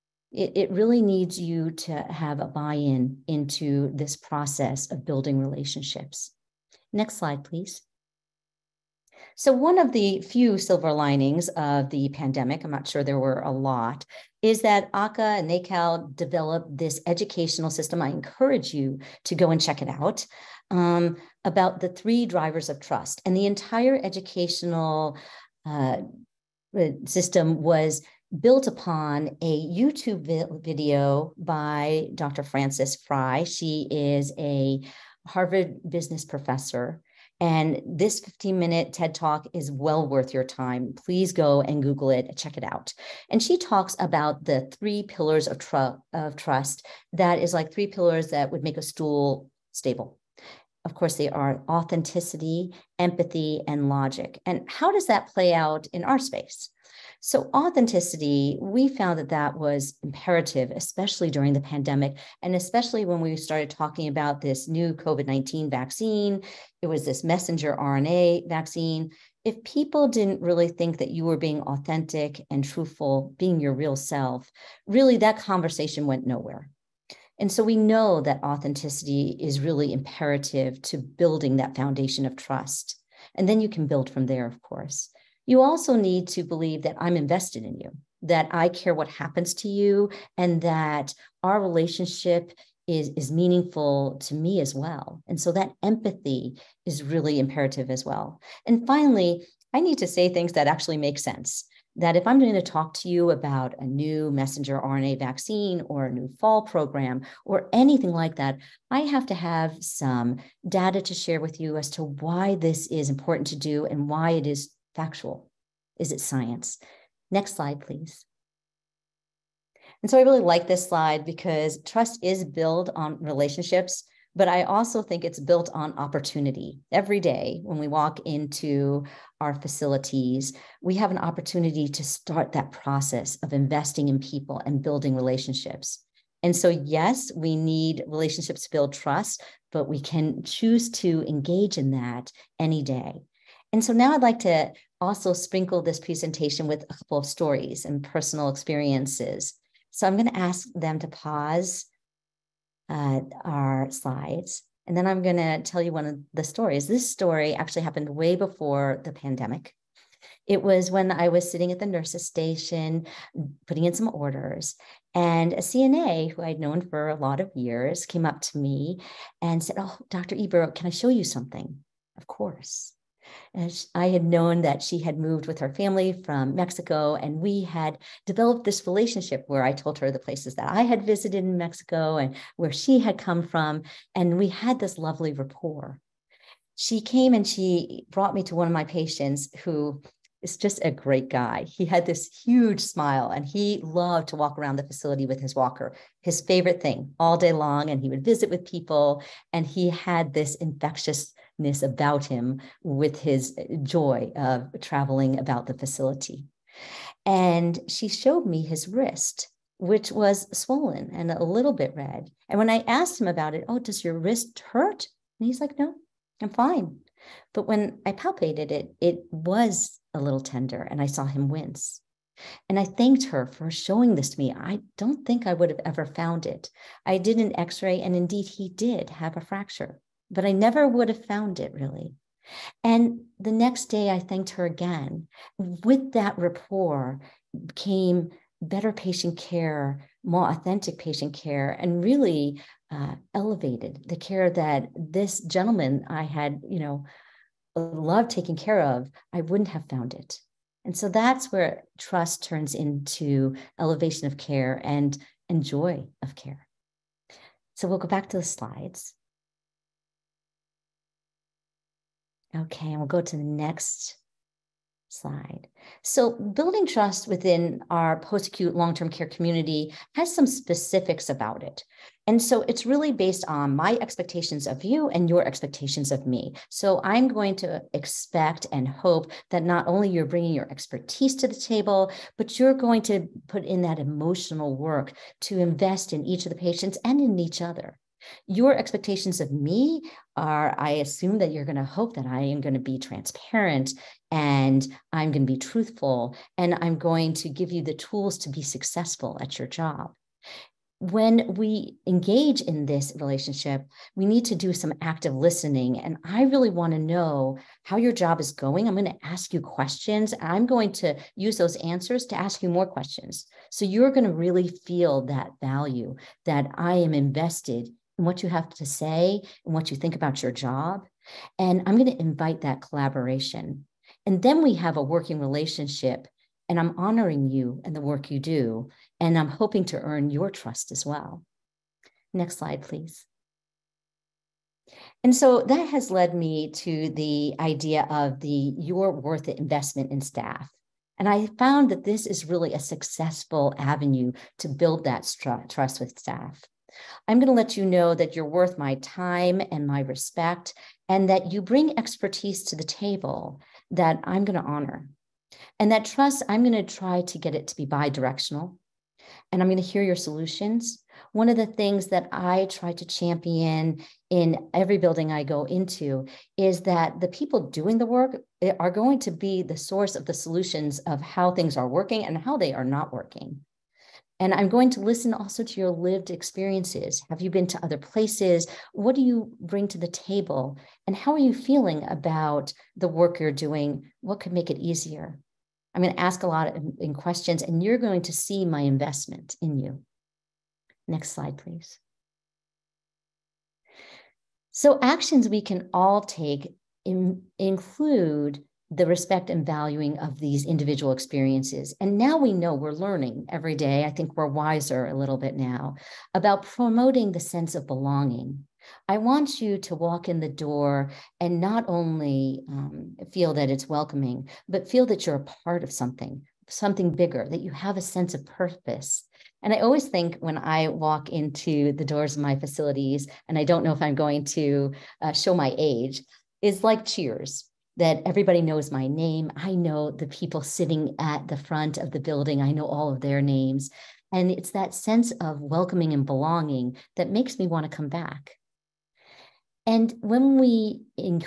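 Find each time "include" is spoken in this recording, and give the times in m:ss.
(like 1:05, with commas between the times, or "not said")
6:37.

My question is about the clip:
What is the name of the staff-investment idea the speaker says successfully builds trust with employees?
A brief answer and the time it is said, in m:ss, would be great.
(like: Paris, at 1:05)
your worth investment, at 5:38.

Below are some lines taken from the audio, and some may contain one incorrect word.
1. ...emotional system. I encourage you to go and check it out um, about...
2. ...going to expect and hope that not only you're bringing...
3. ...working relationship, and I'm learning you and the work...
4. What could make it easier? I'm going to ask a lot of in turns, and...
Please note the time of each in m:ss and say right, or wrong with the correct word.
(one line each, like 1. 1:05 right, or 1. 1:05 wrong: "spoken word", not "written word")
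1. 0:17 wrong: "educational", not "emotional"
2. 4:37 right
3. 5:25 wrong: "honoring", not "learning"
4. 6:24 wrong: "questions", not "turns".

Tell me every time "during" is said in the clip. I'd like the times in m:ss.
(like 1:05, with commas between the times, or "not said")
1:01.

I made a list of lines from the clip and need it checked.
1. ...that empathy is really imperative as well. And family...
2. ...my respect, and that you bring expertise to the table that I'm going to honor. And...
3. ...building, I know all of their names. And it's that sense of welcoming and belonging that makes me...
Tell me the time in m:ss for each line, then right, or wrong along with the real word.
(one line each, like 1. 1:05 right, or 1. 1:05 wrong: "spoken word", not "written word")
1. 1:35 wrong: "finally", not "family"
2. 5:49 right
3. 7:12 right.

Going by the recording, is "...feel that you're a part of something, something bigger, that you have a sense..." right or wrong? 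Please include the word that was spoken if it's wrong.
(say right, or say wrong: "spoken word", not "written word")
right.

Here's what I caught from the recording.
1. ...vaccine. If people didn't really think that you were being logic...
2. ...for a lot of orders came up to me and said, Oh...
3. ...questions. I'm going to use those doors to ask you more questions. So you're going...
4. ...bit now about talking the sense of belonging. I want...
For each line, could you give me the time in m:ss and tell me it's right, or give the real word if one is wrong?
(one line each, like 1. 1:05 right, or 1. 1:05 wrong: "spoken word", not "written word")
1. 1:08 wrong: "authentic", not "logic"
2. 2:46 wrong: "years", not "orders"
3. 5:09 wrong: "answers", not "doors"
4. 6:45 wrong: "promoting", not "talking".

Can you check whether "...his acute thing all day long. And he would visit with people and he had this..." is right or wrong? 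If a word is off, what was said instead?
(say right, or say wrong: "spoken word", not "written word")
wrong: "favorite", not "acute".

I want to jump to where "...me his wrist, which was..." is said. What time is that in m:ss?
3:28.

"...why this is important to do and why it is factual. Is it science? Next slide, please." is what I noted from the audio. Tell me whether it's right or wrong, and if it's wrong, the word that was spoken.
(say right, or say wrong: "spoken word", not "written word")
right.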